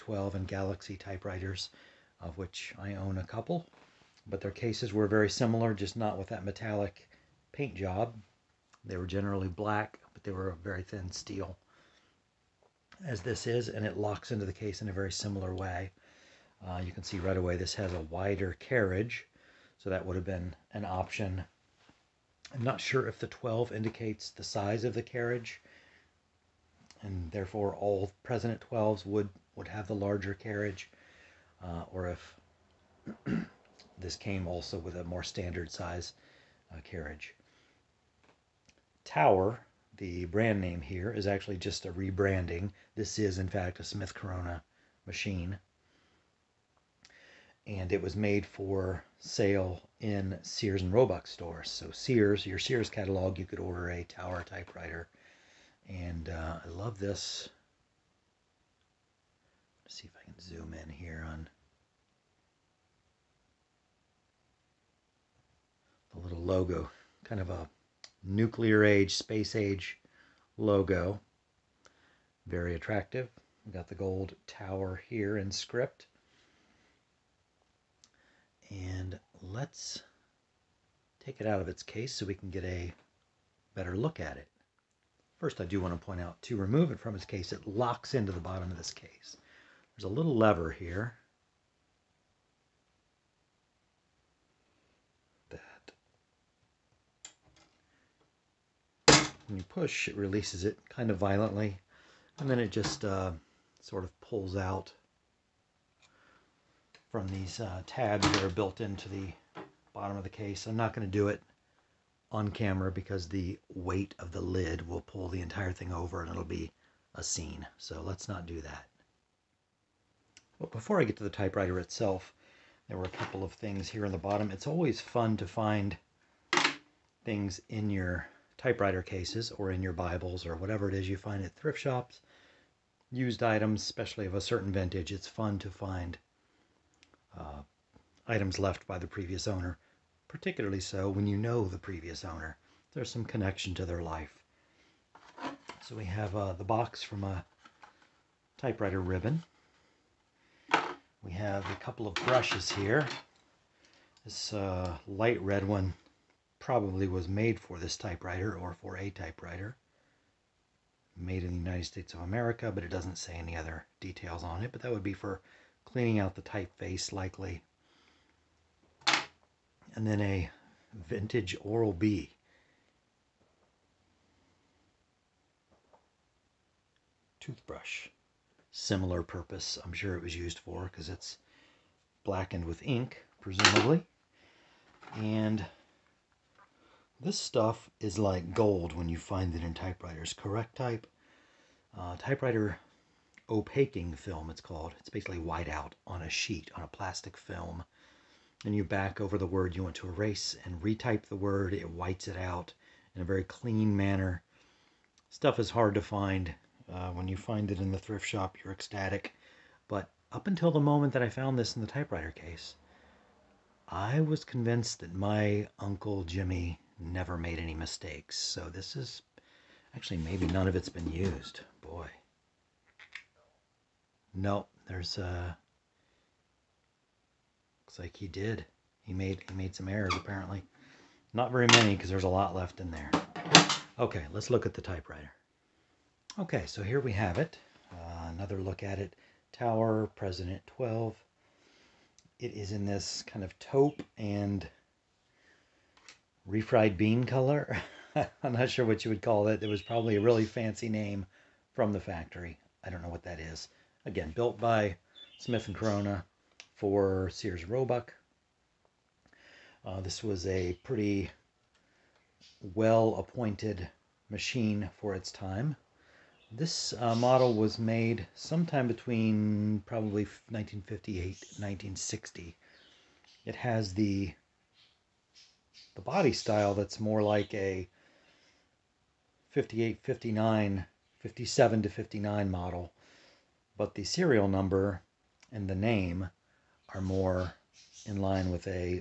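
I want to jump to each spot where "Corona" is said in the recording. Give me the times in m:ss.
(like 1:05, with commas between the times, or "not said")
0:44, 4:15.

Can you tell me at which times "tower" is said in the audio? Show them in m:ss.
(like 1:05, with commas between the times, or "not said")
0:39, 0:54, 1:14, 3:59.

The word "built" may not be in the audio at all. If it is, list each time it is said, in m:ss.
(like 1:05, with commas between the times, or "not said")
1:48, 4:14.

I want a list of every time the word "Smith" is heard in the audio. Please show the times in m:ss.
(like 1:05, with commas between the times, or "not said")
0:43, 4:15.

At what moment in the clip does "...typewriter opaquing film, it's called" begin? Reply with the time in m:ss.
3:12.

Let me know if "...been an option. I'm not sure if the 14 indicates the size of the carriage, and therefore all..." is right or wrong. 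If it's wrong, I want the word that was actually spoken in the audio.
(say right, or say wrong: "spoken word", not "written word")
wrong: "12", not "14".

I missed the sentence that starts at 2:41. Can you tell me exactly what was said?
Made in the United States of America, but it doesn't say any other details on it.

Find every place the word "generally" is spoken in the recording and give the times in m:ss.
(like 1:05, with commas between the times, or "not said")
0:09.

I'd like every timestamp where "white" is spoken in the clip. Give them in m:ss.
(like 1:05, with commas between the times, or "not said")
3:15, 3:21.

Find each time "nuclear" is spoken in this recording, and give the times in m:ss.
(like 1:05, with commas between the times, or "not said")
1:08.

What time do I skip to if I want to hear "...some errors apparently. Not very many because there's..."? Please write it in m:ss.
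3:49.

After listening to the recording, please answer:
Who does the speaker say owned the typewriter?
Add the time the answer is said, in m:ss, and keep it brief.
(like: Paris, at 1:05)
Uncle Jimmy, at 3:35.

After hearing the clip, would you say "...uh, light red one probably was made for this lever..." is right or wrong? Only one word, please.
wrong.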